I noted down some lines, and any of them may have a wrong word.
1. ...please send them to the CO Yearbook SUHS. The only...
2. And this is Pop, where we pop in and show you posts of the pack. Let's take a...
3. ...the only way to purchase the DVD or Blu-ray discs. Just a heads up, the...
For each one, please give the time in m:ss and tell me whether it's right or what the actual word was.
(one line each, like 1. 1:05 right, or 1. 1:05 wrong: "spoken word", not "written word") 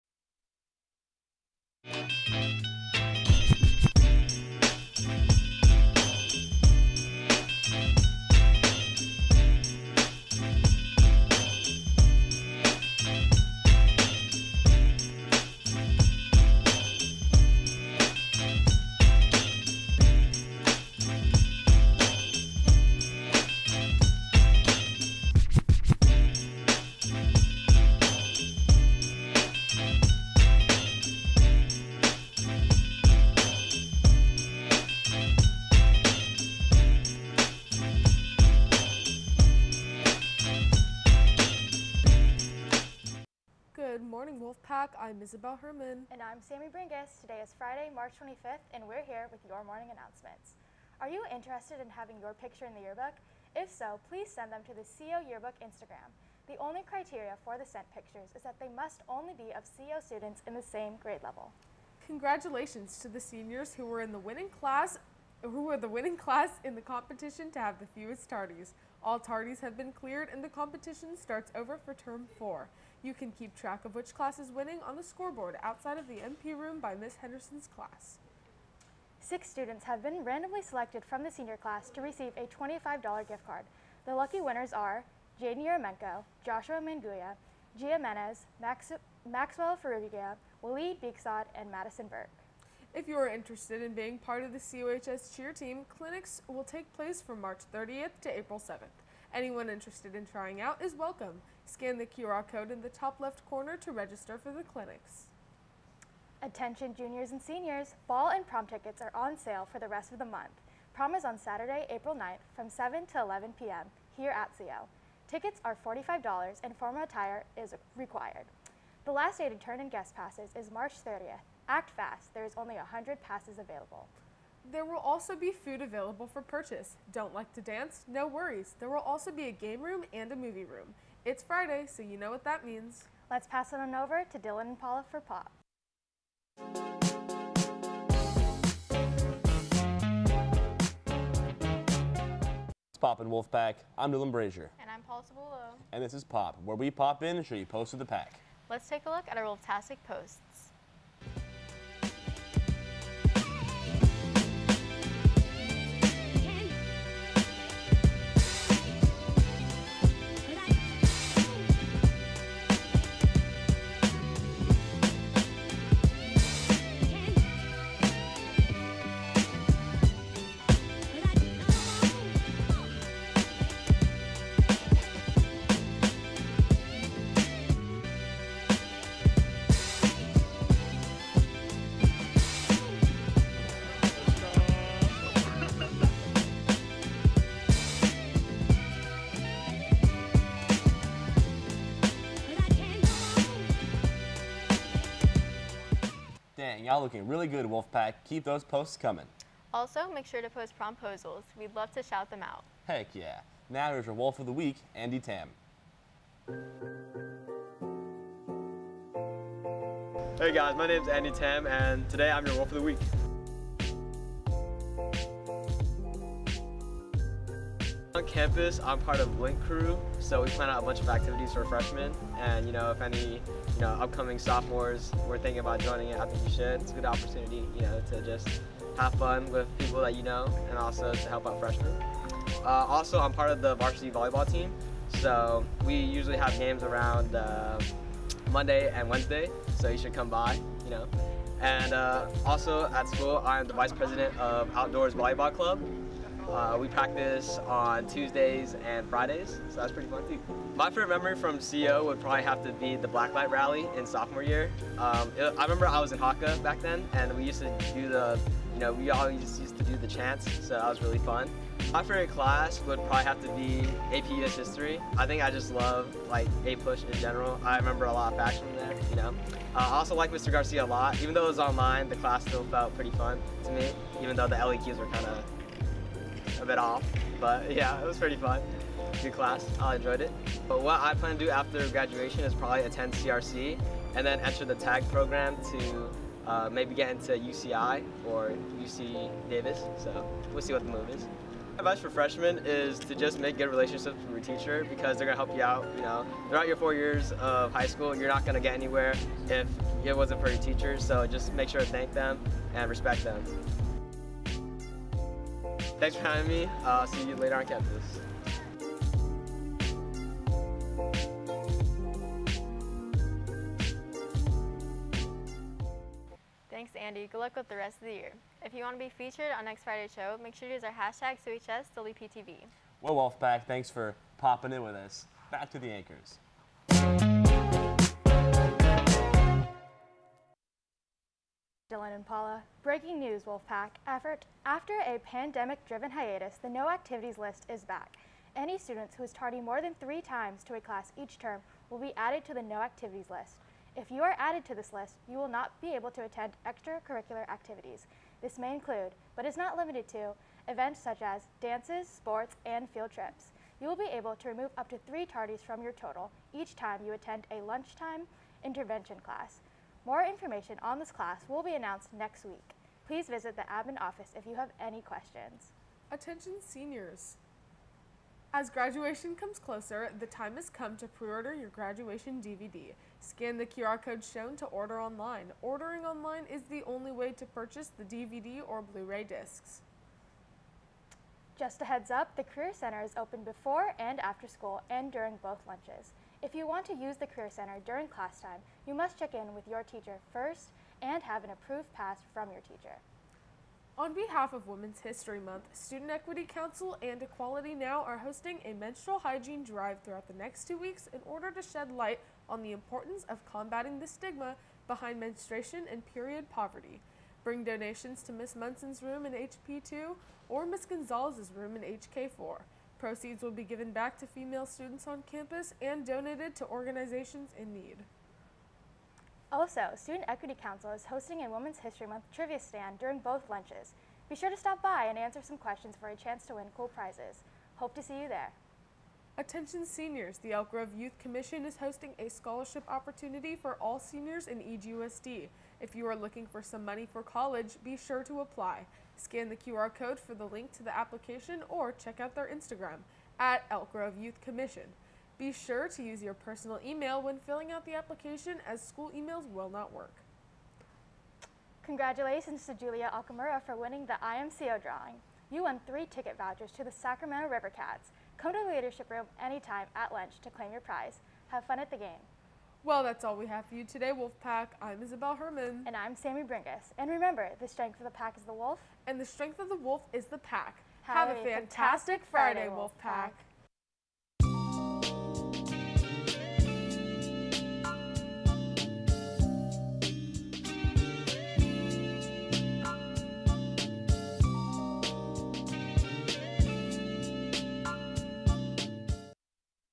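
1. 0:54 wrong: "Instagram", not "SUHS"
2. 2:25 right
3. 6:16 right.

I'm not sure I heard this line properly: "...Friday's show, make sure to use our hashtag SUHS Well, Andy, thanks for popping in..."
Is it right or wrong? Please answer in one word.
wrong.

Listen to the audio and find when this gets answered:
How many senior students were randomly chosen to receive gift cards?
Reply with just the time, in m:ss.
1:19.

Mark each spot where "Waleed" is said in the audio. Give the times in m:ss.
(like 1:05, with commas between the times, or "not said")
1:30.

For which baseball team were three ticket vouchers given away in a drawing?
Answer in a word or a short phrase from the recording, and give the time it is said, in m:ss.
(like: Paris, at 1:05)
Sacramento River Cats, at 7:36.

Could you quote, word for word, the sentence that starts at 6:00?
More information on this class will be announced next week.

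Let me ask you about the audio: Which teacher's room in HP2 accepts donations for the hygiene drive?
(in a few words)
Miss Munson.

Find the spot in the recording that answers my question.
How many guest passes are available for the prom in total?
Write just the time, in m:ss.
2:02.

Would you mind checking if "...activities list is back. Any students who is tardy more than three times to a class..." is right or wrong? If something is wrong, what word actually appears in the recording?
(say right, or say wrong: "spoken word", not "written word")
right.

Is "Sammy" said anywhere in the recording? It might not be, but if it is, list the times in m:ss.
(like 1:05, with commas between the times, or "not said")
0:46, 7:46.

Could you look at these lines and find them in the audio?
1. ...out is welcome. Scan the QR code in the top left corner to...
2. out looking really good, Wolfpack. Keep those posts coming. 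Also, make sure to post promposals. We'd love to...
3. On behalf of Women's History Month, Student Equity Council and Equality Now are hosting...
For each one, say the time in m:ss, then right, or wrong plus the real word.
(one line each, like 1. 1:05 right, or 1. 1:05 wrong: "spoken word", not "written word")
1. 1:40 right
2. 3:16 right
3. 6:33 right.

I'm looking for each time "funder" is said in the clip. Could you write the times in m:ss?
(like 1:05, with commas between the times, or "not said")
not said.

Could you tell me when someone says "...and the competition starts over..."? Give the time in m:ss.
1:10.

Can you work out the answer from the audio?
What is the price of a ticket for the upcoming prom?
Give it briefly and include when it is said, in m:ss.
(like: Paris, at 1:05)
$45, at 1:55.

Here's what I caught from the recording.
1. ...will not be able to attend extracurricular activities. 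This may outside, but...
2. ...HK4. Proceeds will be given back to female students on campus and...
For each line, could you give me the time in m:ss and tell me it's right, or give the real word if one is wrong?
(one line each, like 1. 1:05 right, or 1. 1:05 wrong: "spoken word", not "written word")
1. 5:45 wrong: "include", not "outside"
2. 6:51 right.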